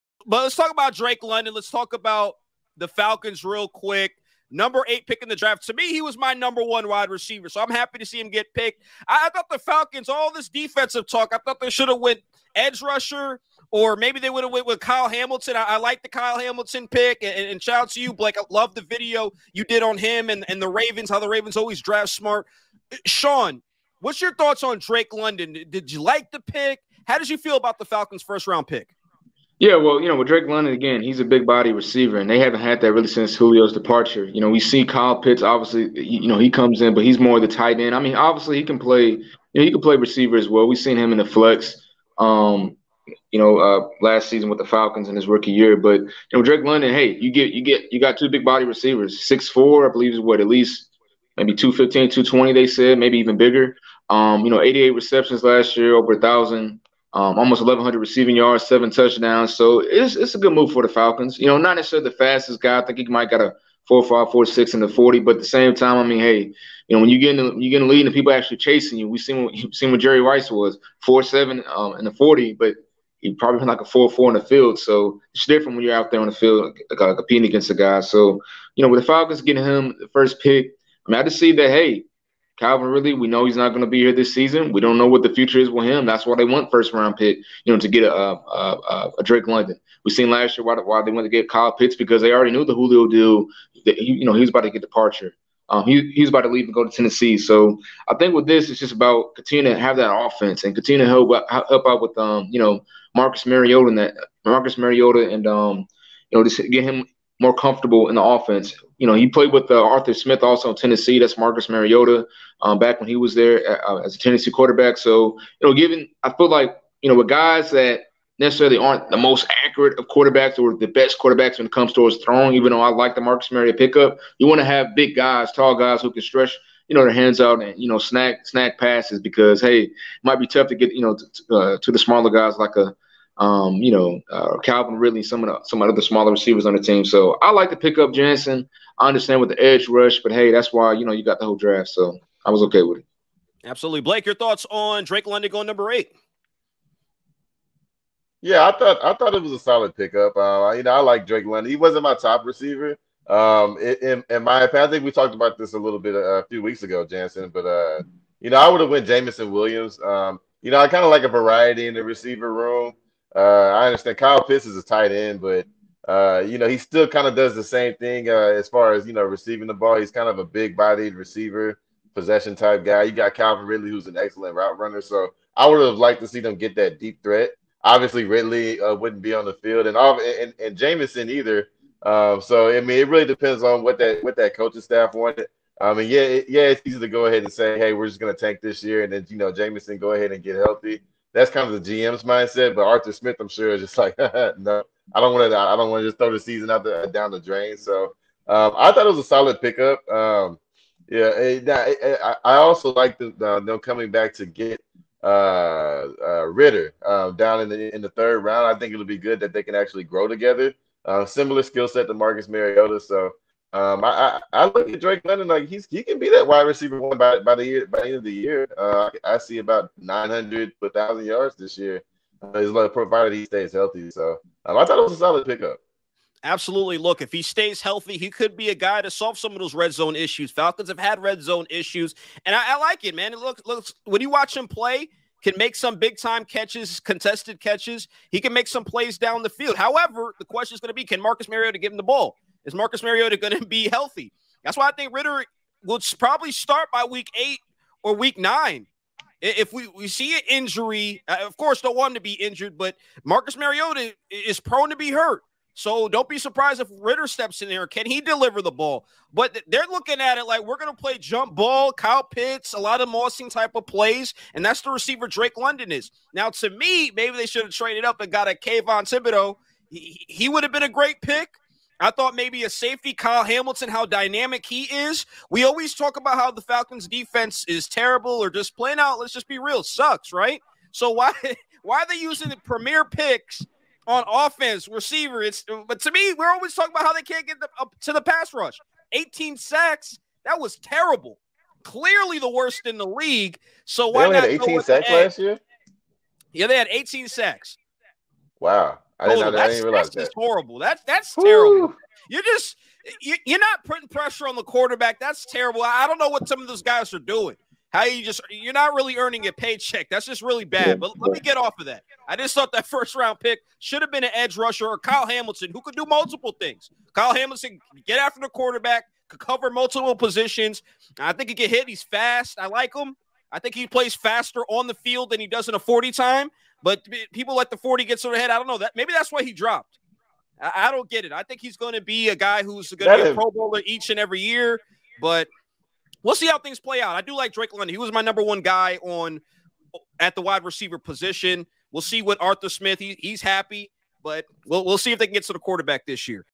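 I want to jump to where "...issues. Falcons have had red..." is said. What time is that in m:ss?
3:50.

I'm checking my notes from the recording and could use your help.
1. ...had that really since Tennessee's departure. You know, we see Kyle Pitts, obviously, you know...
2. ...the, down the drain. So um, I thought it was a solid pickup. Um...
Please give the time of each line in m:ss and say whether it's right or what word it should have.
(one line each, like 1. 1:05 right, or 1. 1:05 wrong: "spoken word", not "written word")
1. 0:32 wrong: "Julio", not "Tennessee"
2. 3:16 right.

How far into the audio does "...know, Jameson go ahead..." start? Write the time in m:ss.
3:09.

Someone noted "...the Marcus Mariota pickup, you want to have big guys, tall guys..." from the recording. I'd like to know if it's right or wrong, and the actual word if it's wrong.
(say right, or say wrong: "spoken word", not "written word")
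right.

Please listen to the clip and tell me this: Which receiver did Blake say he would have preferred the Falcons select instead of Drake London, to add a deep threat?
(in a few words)
Jameson Williams.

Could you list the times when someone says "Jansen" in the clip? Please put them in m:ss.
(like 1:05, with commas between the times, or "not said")
2:18, 2:37.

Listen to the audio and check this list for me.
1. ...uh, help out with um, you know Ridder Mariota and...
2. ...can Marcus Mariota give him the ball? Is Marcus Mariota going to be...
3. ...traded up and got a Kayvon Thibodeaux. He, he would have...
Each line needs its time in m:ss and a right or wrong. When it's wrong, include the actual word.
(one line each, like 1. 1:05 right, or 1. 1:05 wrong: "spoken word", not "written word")
1. 1:41 wrong: "Marcus", not "Ridder"
2. 4:01 right
3. 4:27 right.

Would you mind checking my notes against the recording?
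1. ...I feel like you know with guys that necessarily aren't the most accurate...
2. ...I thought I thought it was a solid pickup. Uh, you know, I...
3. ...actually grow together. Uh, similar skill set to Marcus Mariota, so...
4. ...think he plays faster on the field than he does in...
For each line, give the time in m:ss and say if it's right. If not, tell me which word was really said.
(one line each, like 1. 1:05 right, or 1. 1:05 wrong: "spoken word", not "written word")
1. 1:56 right
2. 2:28 right
3. 3:29 right
4. 5:23 right.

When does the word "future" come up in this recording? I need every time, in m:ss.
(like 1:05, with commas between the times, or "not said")
1:25.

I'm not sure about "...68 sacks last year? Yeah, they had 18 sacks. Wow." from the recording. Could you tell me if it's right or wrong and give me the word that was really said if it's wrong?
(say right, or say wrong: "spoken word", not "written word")
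wrong: "18", not "68".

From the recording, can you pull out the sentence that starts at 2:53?
You got Calvin Ridley, who's an excellent route runner.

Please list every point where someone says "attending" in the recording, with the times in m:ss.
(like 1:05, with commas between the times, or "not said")
not said.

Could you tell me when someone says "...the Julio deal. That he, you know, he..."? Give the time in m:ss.
1:32.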